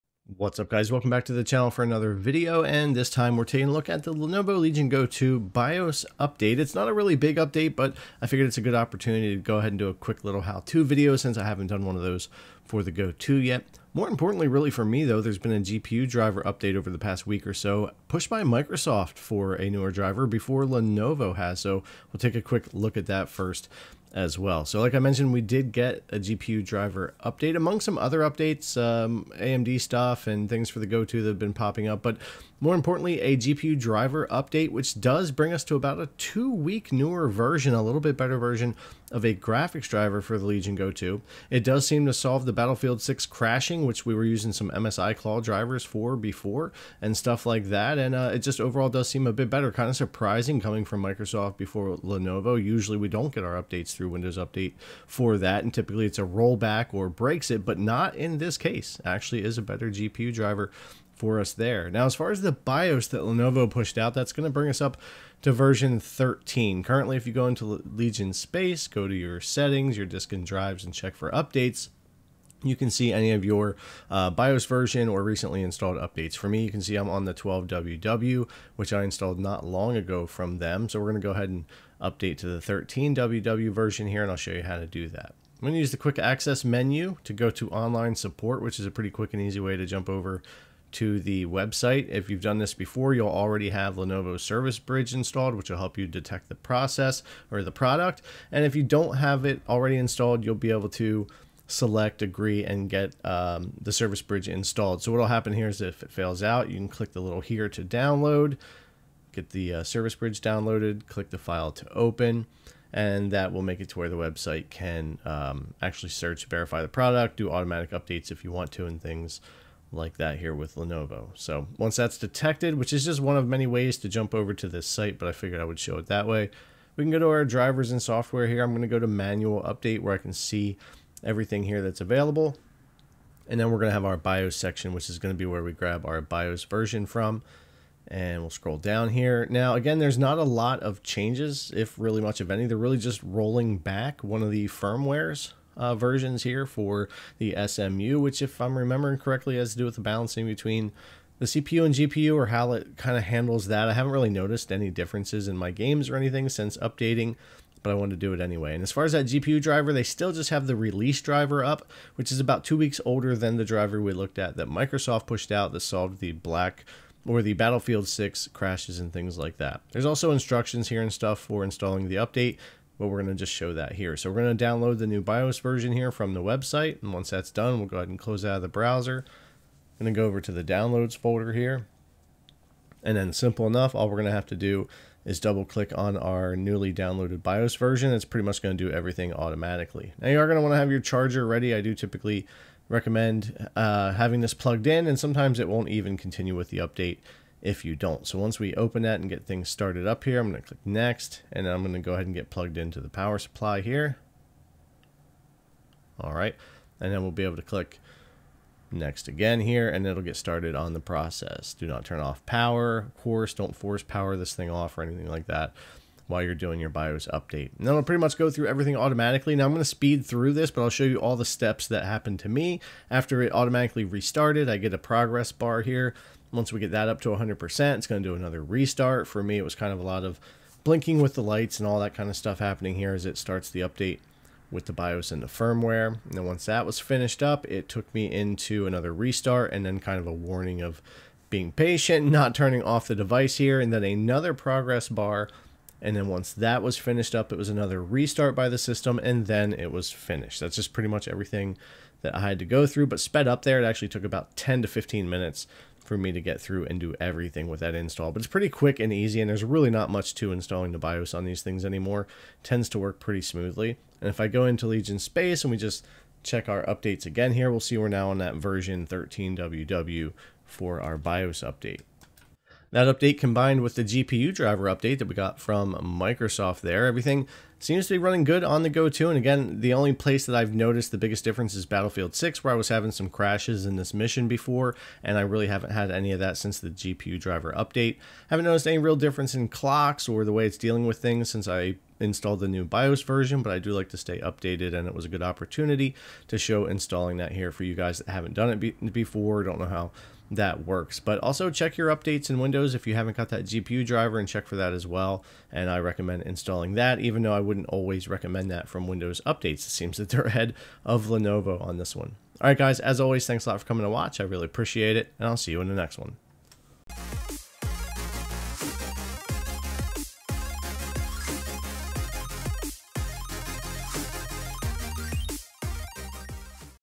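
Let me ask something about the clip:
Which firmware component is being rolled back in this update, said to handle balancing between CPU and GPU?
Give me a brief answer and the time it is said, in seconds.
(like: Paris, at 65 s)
SMU, at 147 s.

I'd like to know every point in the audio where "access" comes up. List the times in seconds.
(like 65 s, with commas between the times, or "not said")
86 s.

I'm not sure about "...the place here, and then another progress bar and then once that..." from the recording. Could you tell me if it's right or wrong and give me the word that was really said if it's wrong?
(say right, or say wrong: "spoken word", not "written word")
wrong: "device", not "place".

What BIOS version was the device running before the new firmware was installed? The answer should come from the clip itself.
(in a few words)
12WW.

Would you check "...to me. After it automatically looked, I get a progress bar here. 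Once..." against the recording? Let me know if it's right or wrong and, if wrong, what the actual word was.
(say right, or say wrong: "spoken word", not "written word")
wrong: "restarted", not "looked".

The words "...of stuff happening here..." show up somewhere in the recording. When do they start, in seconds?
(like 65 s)
232 s.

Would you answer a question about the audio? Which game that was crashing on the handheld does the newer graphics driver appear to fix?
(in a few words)
Battlefield 6.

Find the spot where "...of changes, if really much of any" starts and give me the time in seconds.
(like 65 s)
140 s.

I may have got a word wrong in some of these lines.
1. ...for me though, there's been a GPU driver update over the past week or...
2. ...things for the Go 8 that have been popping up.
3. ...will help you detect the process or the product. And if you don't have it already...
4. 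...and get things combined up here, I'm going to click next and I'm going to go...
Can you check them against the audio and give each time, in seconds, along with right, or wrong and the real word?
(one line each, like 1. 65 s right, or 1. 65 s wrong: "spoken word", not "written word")
1. 14 s right
2. 30 s wrong: "2", not "8"
3. 95 s right
4. 199 s wrong: "started", not "combined".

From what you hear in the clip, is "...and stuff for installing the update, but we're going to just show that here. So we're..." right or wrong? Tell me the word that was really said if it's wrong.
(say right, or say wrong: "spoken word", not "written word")
right.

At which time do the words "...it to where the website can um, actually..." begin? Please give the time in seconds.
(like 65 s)
113 s.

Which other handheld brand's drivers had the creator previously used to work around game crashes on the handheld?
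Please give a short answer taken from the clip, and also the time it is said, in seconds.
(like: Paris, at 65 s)
MSI Claw, at 44 s.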